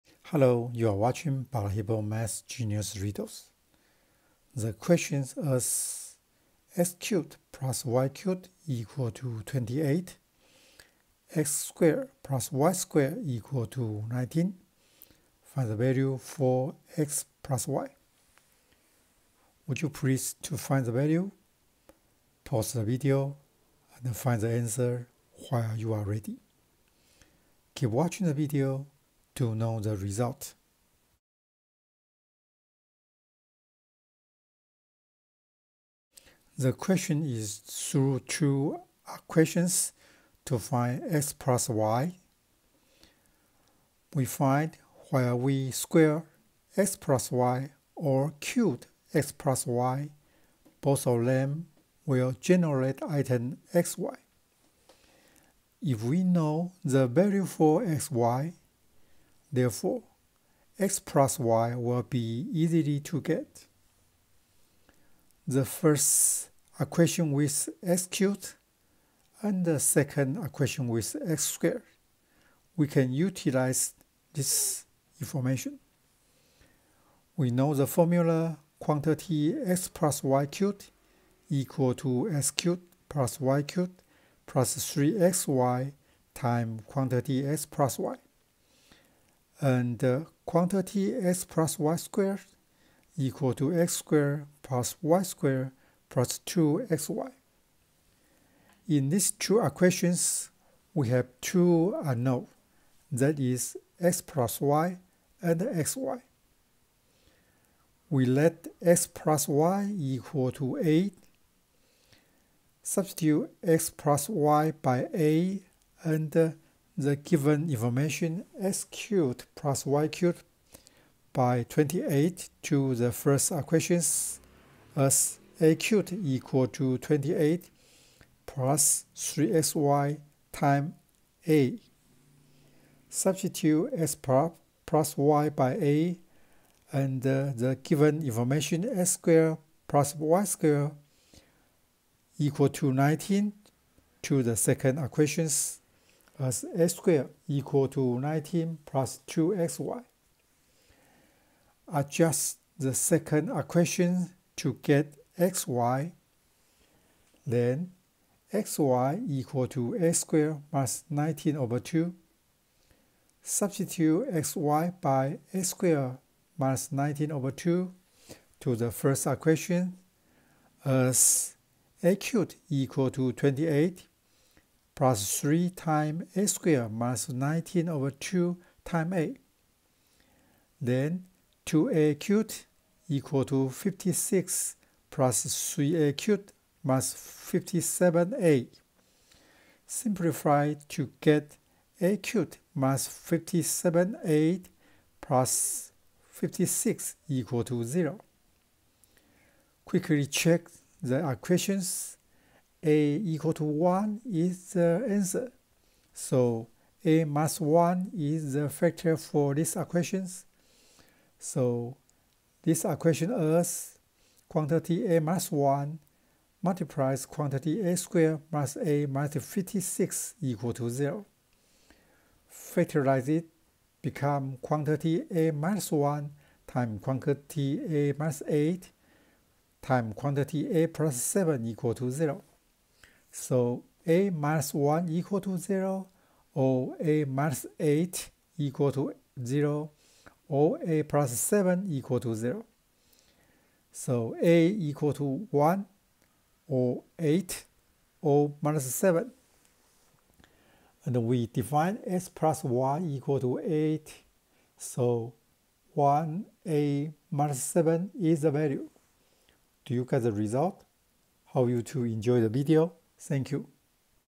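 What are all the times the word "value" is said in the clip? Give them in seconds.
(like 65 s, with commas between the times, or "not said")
15 s, 20 s, 57 s, 258 s.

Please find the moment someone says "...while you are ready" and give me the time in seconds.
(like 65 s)
25 s.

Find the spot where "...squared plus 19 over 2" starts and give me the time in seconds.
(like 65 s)
160 s.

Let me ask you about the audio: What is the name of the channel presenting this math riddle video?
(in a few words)
Balahippo Math Genius Riddles.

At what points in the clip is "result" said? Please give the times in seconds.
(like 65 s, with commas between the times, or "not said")
29 s, 260 s.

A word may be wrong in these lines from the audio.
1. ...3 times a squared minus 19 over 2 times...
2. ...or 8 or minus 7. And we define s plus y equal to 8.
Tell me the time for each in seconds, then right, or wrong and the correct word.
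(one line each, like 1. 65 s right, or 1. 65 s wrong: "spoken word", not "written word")
1. 175 s right
2. 246 s right.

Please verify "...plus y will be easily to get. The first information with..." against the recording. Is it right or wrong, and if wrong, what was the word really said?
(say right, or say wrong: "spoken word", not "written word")
wrong: "equation", not "information".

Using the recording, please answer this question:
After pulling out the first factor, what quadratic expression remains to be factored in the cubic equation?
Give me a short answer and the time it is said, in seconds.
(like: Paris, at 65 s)
a² - a - 56, at 217 s.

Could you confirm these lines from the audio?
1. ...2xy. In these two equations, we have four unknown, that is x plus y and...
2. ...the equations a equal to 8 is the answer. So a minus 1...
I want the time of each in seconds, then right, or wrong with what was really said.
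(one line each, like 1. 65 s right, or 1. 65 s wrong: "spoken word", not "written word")
1. 96 s wrong: "two", not "four"
2. 201 s wrong: "1", not "8".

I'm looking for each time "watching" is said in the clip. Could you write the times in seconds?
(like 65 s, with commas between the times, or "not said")
0 s, 27 s.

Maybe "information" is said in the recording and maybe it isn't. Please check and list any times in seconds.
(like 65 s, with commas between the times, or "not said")
75 s, 117 s, 138 s.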